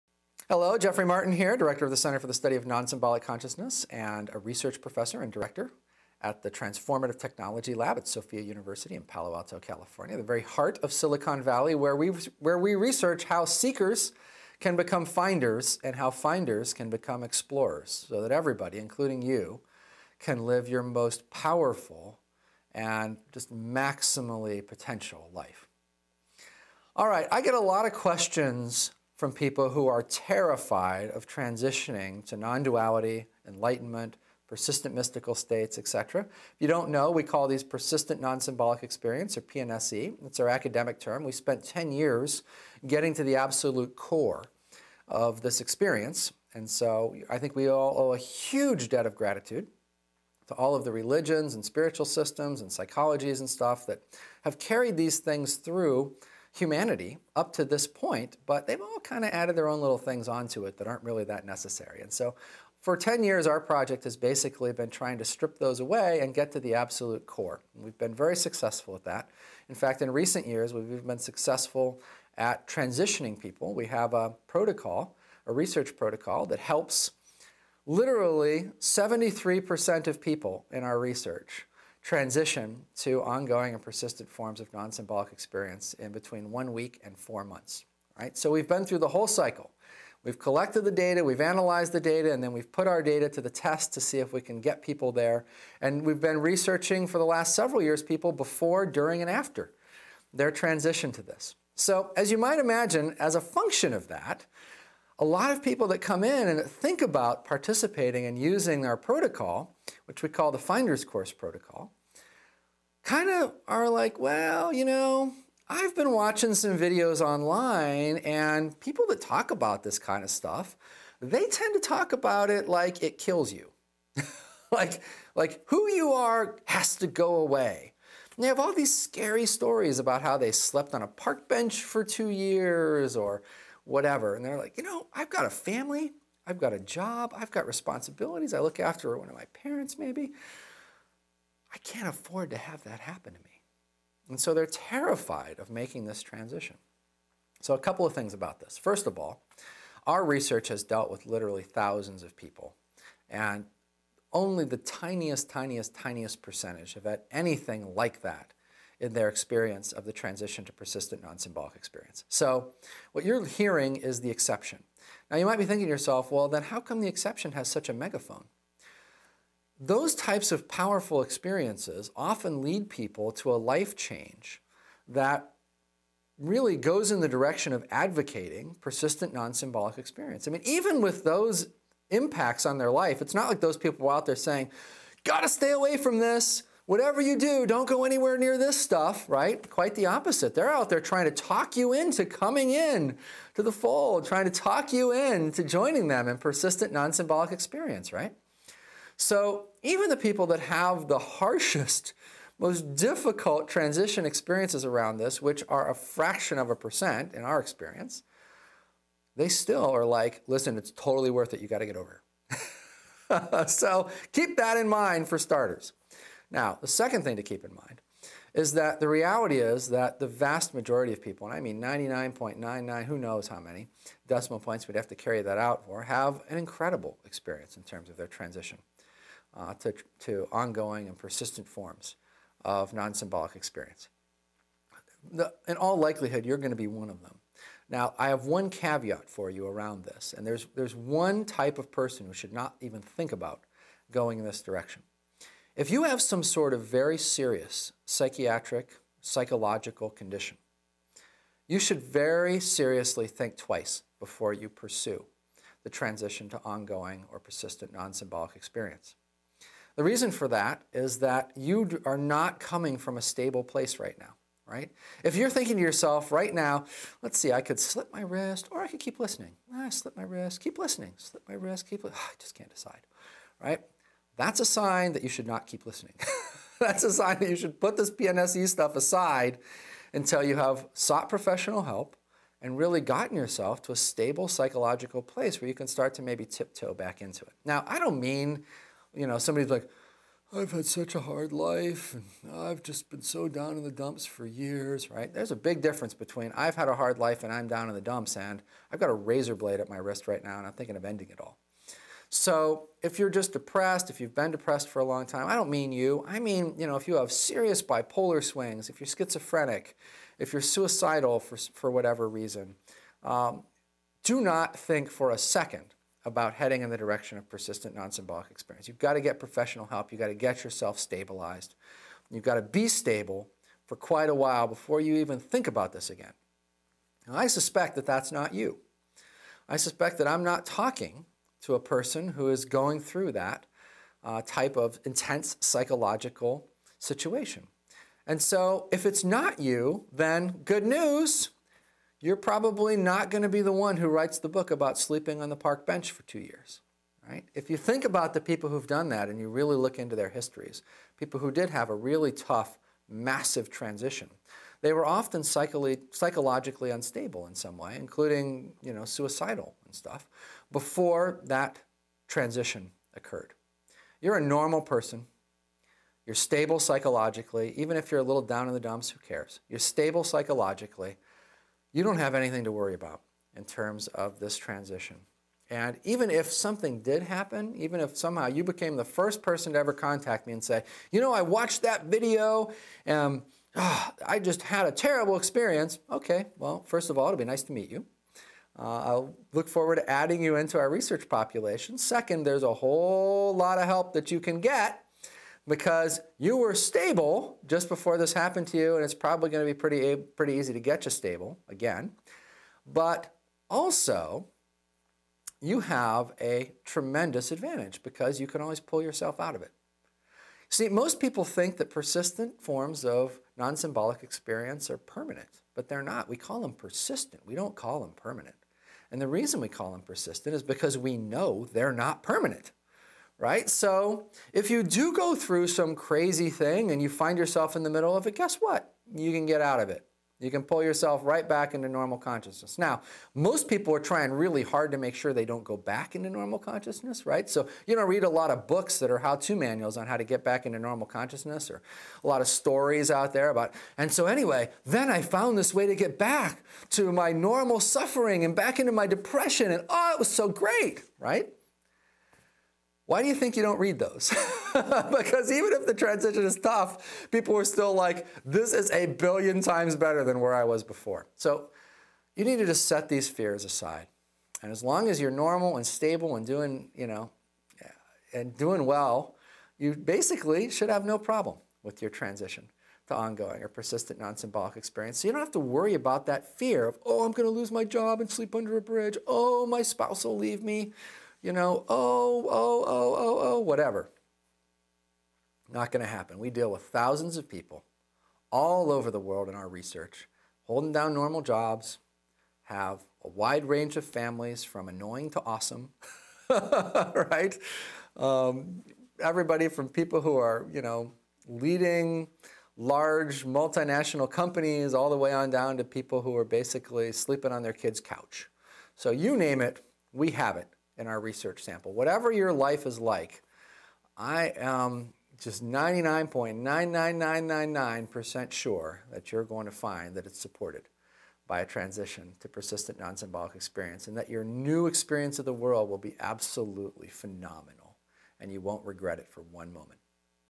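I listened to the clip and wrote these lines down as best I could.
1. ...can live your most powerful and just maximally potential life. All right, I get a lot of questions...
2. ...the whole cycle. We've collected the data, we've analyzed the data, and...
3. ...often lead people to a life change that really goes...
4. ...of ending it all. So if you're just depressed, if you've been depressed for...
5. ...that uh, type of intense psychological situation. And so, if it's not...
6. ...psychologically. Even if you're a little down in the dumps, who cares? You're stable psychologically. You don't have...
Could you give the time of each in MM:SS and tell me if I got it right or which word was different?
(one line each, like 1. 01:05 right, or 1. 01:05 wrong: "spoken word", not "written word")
1. 00:20 right
2. 01:28 right
3. 02:52 right
4. 05:00 right
5. 05:33 right
6. 06:06 right.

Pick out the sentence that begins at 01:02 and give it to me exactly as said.
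And so for 10 years, our project has basically been trying to strip those away and get to the absolute core.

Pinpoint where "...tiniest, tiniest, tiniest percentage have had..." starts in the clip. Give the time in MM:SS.
02:34.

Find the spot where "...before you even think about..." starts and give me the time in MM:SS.
05:24.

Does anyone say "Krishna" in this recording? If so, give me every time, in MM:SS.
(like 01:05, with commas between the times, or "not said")
not said.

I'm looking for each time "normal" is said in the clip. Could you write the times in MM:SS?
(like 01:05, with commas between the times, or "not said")
06:04, 07:11, 07:16, 07:20, 07:27, 07:45, 08:11.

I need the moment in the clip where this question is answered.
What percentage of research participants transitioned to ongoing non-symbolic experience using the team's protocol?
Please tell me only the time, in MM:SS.
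01:18.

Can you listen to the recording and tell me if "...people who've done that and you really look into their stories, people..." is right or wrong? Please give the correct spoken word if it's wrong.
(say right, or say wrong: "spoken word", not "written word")
wrong: "histories", not "stories".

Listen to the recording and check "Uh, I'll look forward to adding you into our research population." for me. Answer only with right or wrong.
right.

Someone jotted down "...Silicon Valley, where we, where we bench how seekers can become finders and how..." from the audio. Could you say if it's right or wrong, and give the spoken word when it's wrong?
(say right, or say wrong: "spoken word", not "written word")
wrong: "research", not "bench".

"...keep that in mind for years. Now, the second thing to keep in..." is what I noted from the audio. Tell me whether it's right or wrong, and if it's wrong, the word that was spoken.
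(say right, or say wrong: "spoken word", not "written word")
wrong: "starters", not "years".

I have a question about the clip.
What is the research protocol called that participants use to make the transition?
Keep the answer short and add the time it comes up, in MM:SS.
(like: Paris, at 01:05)
Finder's Course Protocol, at 01:50.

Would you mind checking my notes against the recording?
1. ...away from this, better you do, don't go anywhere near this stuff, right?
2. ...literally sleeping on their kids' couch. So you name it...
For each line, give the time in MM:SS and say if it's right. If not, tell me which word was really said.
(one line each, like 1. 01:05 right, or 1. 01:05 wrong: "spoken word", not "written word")
1. 03:05 wrong: "whatever", not "better"
2. 08:26 wrong: "basically", not "literally".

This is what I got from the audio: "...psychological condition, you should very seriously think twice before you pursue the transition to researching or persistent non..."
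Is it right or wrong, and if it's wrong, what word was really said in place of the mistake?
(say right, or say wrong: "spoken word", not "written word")
wrong: "ongoing", not "researching".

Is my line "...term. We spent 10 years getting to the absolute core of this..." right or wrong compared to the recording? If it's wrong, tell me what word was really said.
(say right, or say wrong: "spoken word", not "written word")
right.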